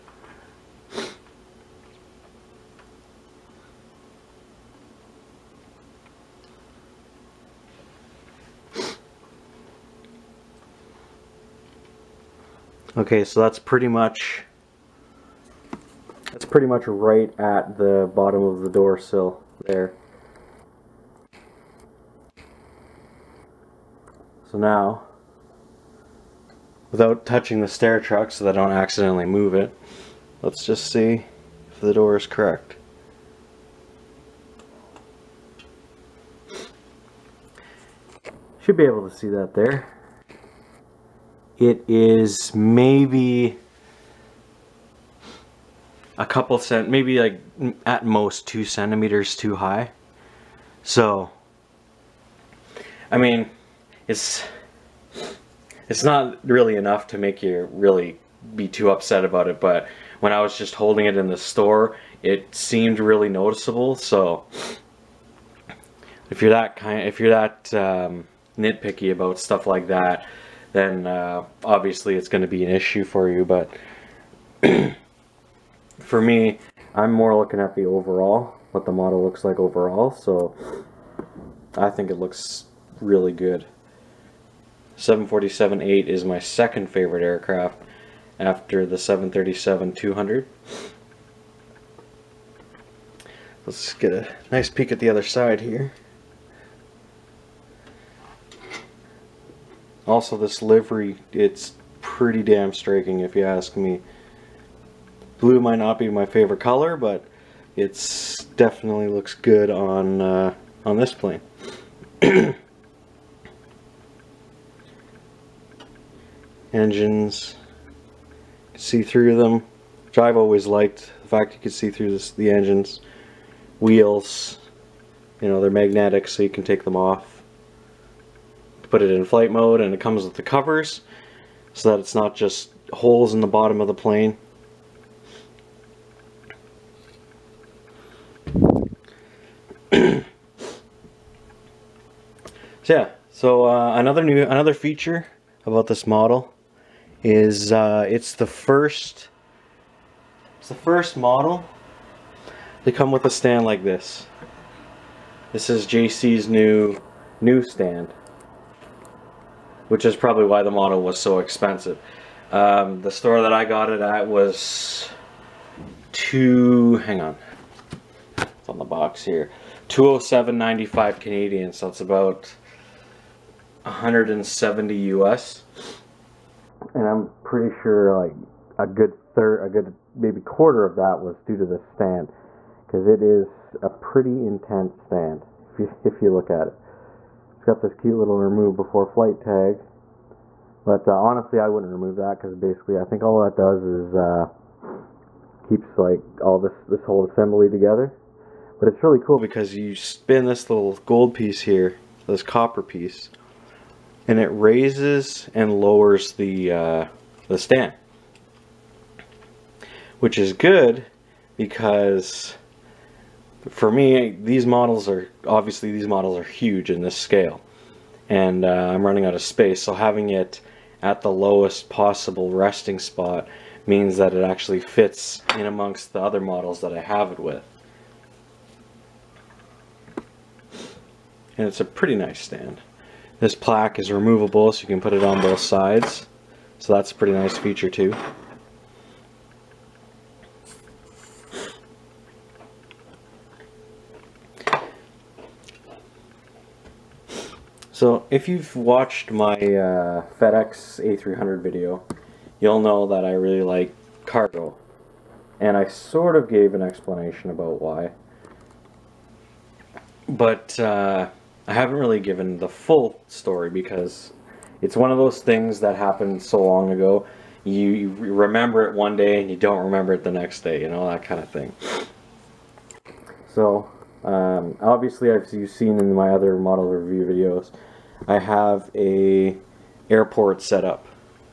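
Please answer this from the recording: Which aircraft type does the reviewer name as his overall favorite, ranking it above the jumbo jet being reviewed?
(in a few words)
737-200.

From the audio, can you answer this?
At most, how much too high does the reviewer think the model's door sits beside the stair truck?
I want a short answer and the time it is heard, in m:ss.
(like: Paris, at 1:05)
2 centimeters, at 0:48.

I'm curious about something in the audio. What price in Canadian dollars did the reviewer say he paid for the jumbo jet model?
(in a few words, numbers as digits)
207.95.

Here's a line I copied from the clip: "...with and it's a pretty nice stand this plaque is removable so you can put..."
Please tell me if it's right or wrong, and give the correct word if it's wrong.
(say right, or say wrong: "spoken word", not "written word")
right.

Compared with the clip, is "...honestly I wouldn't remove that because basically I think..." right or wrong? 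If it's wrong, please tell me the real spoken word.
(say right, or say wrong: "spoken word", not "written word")
right.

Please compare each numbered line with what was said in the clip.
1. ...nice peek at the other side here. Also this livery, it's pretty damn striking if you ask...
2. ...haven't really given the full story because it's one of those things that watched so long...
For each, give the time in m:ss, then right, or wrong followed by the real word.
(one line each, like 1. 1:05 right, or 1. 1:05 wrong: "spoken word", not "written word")
1. 1:34 right
2. 4:21 wrong: "happened", not "watched".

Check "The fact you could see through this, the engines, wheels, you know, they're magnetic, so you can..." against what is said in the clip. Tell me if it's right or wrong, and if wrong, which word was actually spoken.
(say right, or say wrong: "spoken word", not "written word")
right.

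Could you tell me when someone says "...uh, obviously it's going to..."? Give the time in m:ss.
1:11.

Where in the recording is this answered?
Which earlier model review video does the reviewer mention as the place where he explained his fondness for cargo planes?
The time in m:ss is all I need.
4:10.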